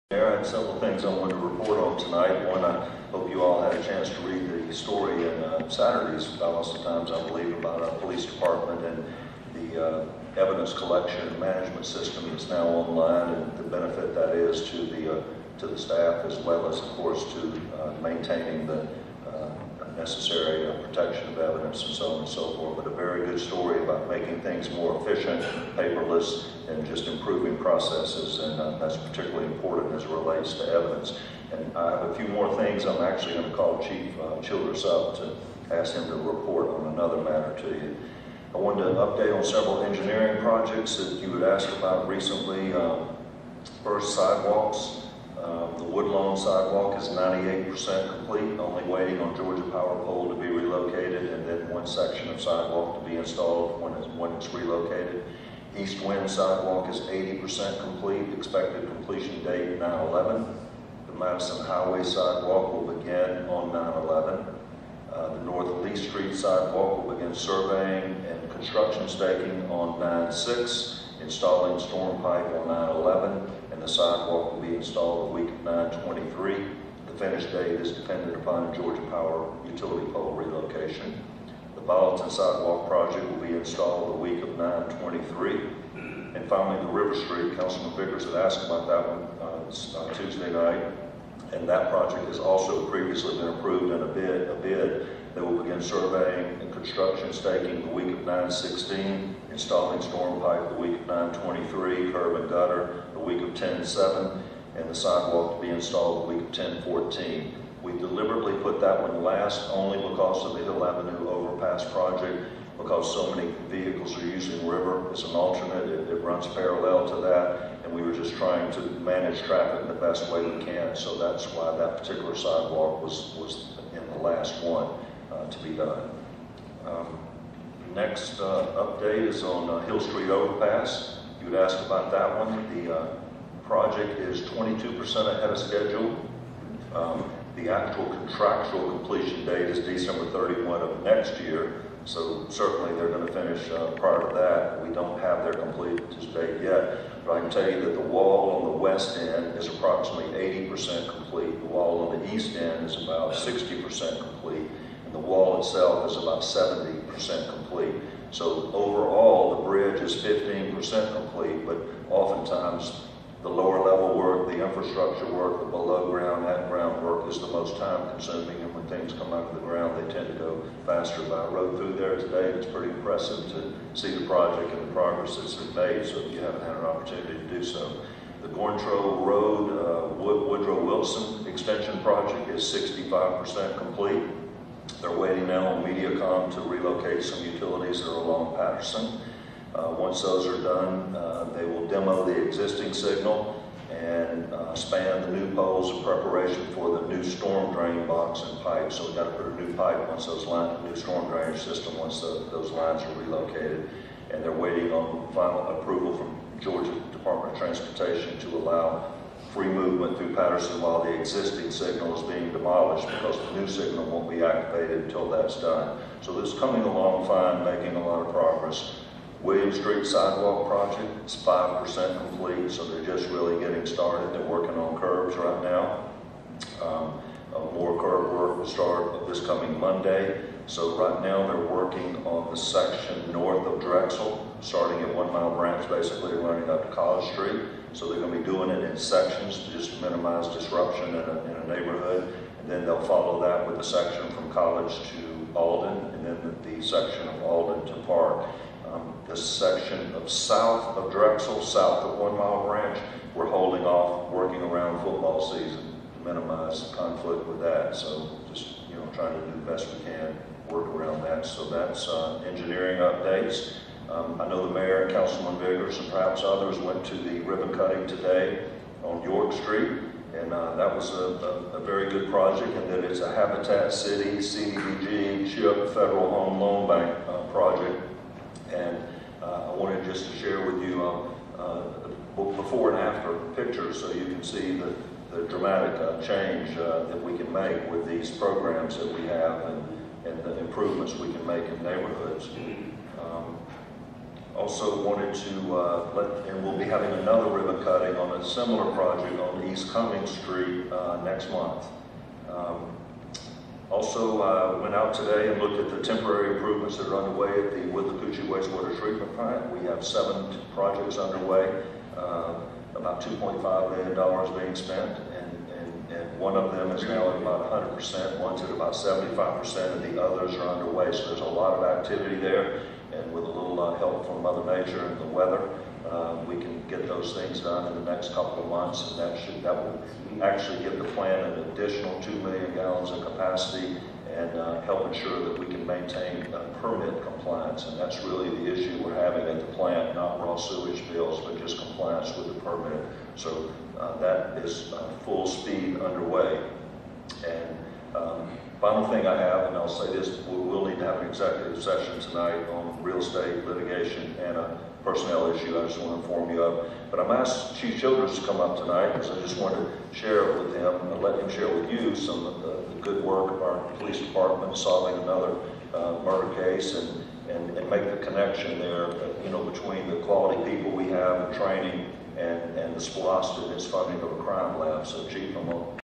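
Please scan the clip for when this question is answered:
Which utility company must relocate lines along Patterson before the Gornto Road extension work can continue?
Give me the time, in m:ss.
3:05.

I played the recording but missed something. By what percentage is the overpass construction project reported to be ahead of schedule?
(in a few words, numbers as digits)
22%.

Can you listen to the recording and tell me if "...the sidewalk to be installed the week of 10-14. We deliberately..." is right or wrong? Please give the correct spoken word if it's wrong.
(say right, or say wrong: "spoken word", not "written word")
right.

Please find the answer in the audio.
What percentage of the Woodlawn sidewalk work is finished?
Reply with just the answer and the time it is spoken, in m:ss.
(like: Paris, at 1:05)
98%, at 0:47.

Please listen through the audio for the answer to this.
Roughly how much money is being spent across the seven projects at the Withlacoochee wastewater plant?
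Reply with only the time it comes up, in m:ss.
5:13.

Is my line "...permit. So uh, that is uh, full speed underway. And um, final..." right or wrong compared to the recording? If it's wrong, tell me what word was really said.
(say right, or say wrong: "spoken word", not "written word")
right.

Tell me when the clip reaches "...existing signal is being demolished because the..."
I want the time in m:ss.
3:31.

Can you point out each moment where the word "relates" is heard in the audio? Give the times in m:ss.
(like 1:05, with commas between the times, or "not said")
0:30.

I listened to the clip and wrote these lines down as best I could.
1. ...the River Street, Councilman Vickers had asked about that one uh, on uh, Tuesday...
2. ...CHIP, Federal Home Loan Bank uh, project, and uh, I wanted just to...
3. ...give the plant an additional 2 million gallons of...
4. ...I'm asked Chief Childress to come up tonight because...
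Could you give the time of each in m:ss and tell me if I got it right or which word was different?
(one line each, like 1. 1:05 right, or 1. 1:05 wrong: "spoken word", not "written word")
1. 1:26 right
2. 4:35 right
3. 5:30 right
4. 5:57 right.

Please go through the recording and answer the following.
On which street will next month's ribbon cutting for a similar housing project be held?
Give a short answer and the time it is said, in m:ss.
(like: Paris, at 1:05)
East Cummings Street, at 4:59.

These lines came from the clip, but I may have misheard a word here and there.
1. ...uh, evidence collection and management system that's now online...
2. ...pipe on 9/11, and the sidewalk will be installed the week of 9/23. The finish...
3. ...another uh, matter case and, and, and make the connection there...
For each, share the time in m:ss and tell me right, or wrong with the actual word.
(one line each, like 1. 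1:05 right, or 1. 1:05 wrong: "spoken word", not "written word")
1. 0:09 right
2. 1:12 right
3. 6:05 wrong: "murder", not "matter".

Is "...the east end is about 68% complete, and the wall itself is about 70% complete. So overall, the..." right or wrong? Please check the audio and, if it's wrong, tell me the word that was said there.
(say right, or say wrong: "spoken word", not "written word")
wrong: "60", not "68".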